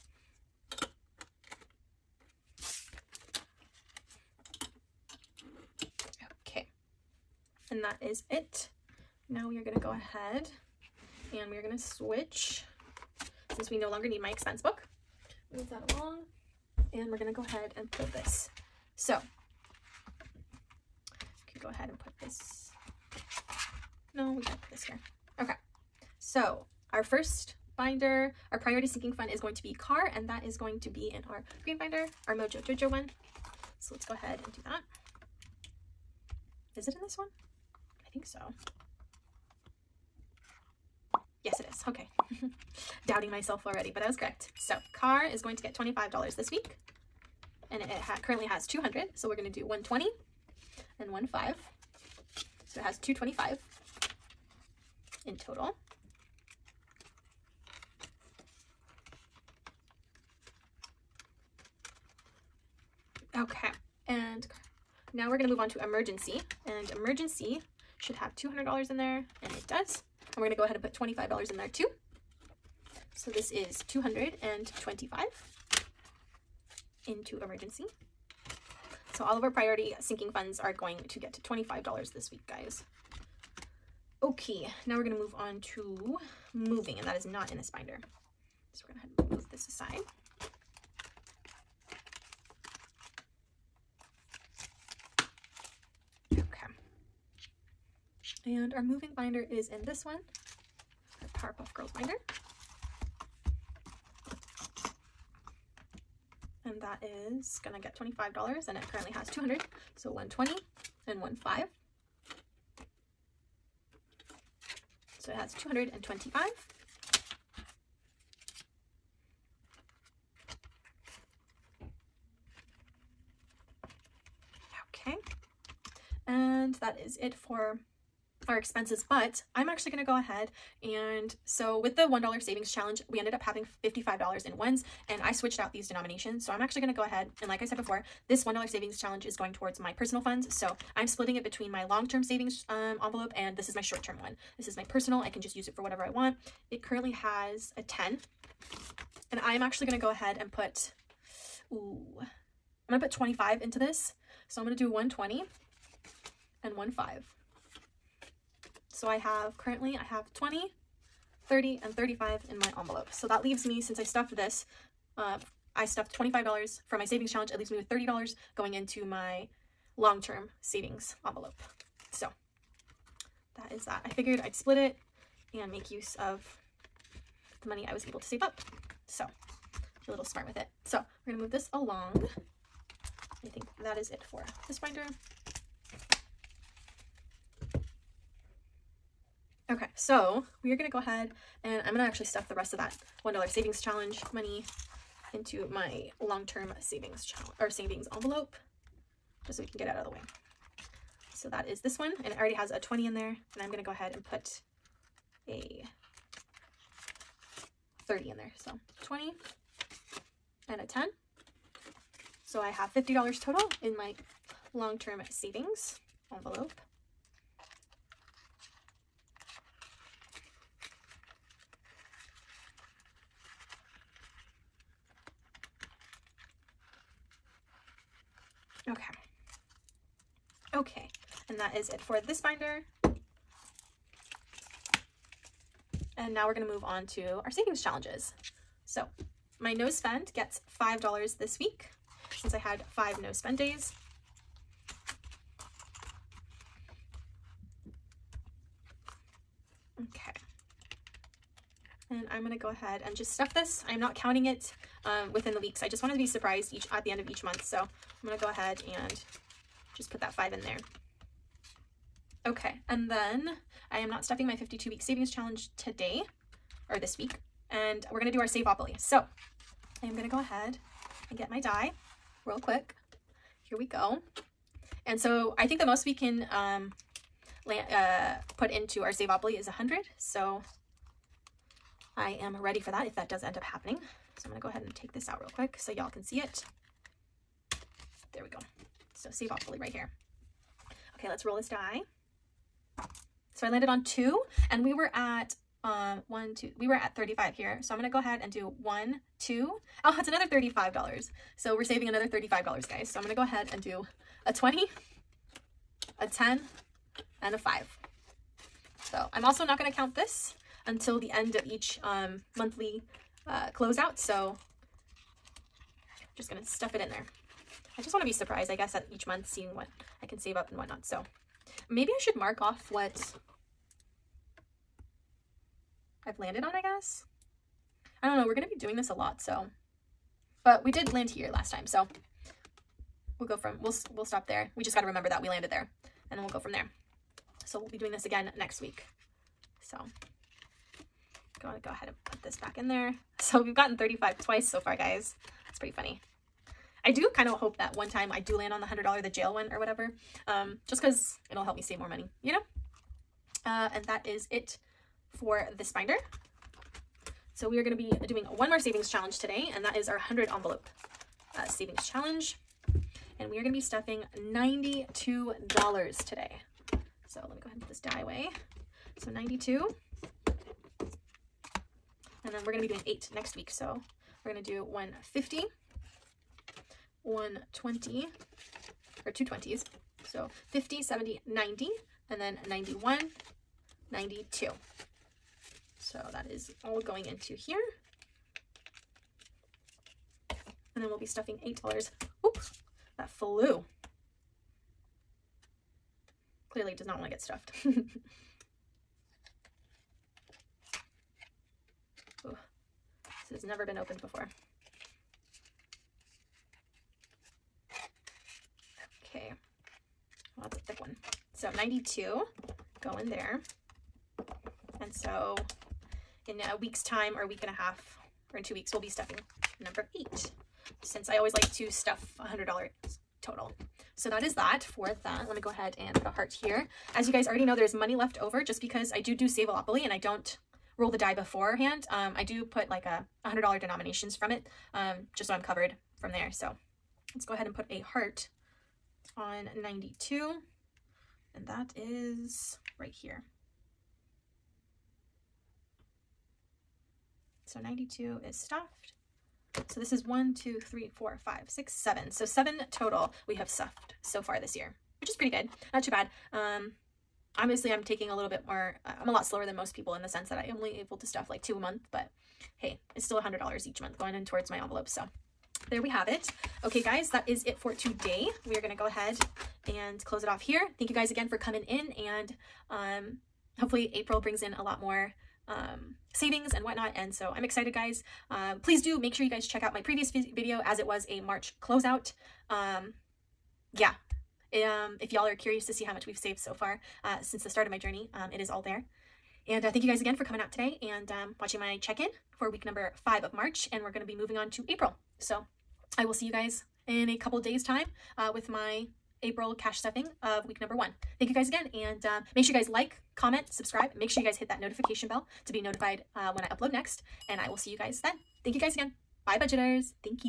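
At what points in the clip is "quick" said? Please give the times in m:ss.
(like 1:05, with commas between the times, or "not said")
4:32, 4:45.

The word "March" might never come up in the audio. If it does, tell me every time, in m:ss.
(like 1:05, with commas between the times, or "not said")
8:01, 8:13.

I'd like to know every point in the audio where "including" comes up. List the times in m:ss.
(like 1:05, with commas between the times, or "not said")
not said.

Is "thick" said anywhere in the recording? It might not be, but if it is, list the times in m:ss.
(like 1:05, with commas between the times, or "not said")
6:50.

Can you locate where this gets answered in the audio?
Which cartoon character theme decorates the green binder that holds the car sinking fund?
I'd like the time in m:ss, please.
0:32.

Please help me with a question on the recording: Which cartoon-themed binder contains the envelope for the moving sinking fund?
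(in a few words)
Powerpuff Girls.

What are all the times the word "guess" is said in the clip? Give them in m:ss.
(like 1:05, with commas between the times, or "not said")
5:18, 5:26.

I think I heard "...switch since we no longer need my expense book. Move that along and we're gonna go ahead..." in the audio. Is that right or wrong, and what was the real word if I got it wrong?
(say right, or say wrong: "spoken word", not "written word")
right.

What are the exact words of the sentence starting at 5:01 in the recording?
So we're saving another $35, guys.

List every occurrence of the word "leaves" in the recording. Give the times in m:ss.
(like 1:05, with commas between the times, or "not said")
2:43, 2:47.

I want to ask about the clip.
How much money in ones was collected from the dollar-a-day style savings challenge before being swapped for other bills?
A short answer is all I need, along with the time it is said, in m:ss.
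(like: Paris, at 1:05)
$55, at 2:13.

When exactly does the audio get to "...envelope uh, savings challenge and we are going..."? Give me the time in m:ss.
6:00.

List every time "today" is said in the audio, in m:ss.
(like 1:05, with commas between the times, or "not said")
4:25, 5:59, 6:06, 7:47, 8:10.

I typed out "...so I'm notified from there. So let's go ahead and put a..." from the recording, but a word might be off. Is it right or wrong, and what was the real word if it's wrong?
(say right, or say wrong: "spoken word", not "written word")
wrong: "covered", not "notified".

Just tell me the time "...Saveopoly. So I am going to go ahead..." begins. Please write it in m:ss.
4:28.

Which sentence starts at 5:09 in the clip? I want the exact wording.
So I'm also not going to count this until the end of each um, monthly uh, closeout.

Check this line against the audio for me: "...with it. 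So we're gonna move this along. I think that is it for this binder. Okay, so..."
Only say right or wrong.
right.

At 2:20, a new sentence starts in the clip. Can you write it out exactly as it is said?
So I'm splitting it between my long-term savings um, envelope and this is my short-term one.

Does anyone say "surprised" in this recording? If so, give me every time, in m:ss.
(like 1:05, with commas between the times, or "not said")
4:16, 5:18.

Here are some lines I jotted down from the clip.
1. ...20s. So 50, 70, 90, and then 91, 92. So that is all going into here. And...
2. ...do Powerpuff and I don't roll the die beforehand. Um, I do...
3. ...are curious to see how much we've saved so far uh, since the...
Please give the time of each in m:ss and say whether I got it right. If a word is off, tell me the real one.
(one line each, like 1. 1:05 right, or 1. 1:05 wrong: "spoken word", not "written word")
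1. 6:19 right
2. 7:09 wrong: "Savealopoly", not "Powerpuff"
3. 8:05 right.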